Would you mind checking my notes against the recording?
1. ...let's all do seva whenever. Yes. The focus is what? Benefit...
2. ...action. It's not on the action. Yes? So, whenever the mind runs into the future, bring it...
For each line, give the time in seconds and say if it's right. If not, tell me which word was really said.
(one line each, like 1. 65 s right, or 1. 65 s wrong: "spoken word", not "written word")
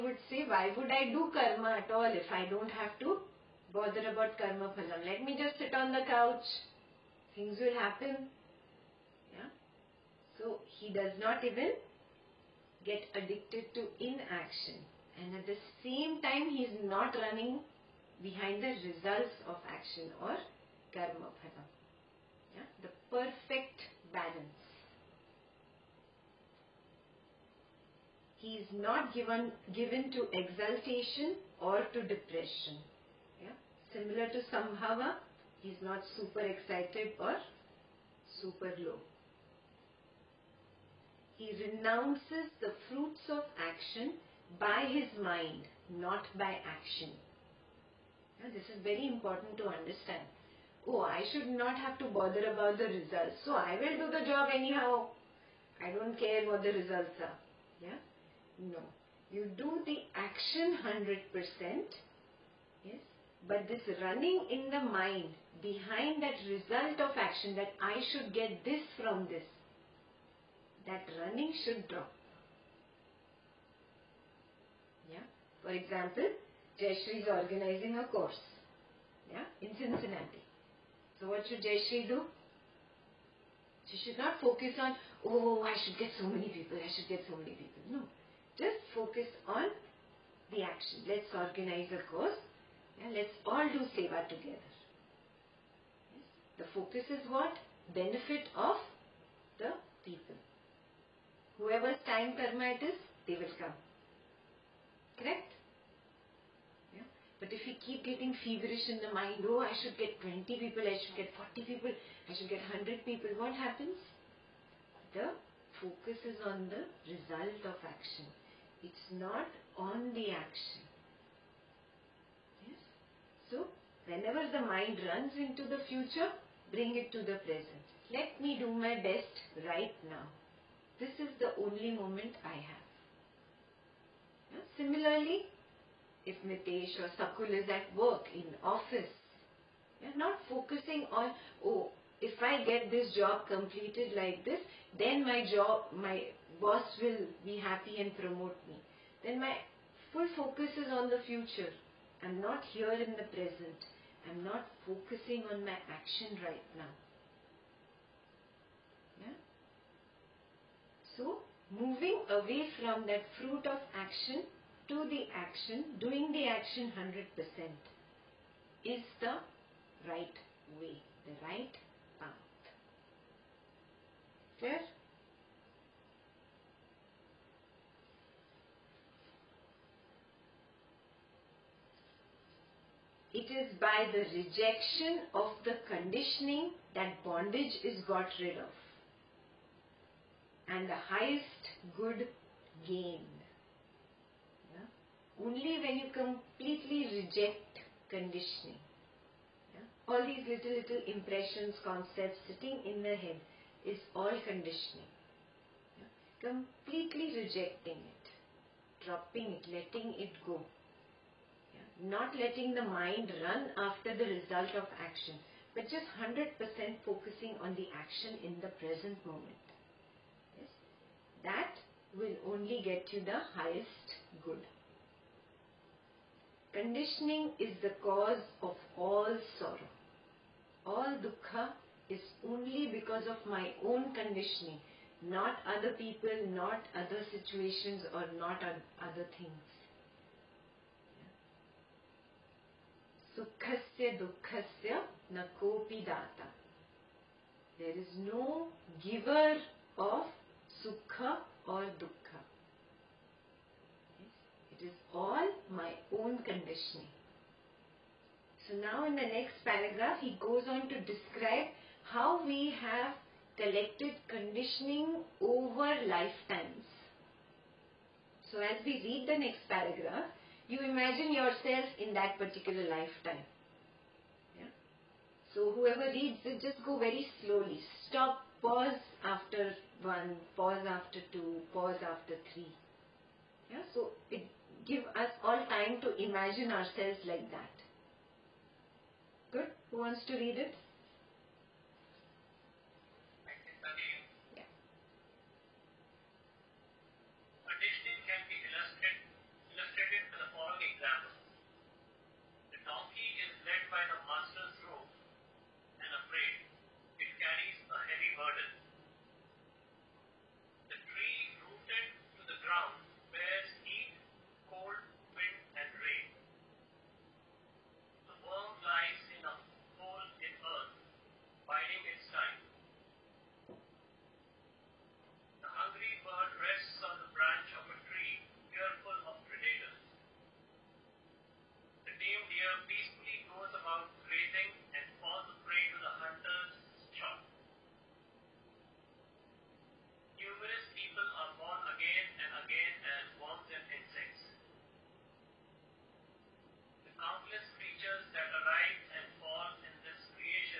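1. 93 s wrong: "together", not "whenever"
2. 117 s right.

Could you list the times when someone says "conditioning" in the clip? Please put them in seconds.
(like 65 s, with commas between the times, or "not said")
185 s, 198 s, 204 s, 226 s, 234 s, 256 s, 264 s.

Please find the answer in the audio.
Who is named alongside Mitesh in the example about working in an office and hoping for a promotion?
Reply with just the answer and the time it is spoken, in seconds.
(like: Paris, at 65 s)
Sakul, at 137 s.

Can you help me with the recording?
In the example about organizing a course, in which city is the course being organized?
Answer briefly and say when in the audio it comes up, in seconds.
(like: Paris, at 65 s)
Cincinnati, at 79 s.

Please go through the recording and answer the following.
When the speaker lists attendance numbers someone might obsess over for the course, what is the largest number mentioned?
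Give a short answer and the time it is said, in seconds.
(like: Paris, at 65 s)
100, at 112 s.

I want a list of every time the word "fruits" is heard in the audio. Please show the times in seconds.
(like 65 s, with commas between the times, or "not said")
42 s, 163 s.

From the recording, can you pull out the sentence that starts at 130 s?
This is the only moment I have.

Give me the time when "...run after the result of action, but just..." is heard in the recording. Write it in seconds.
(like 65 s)
213 s.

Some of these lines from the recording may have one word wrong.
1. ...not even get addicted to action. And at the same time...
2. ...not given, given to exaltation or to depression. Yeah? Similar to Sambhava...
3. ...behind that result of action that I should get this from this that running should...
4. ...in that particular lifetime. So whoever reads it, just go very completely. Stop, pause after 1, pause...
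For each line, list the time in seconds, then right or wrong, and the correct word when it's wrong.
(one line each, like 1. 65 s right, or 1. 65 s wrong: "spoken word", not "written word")
1. 11 s wrong: "inaction", not "action"
2. 28 s right
3. 65 s right
4. 271 s wrong: "slowly", not "completely".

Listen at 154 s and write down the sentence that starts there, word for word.
I'm not focusing on my action right now.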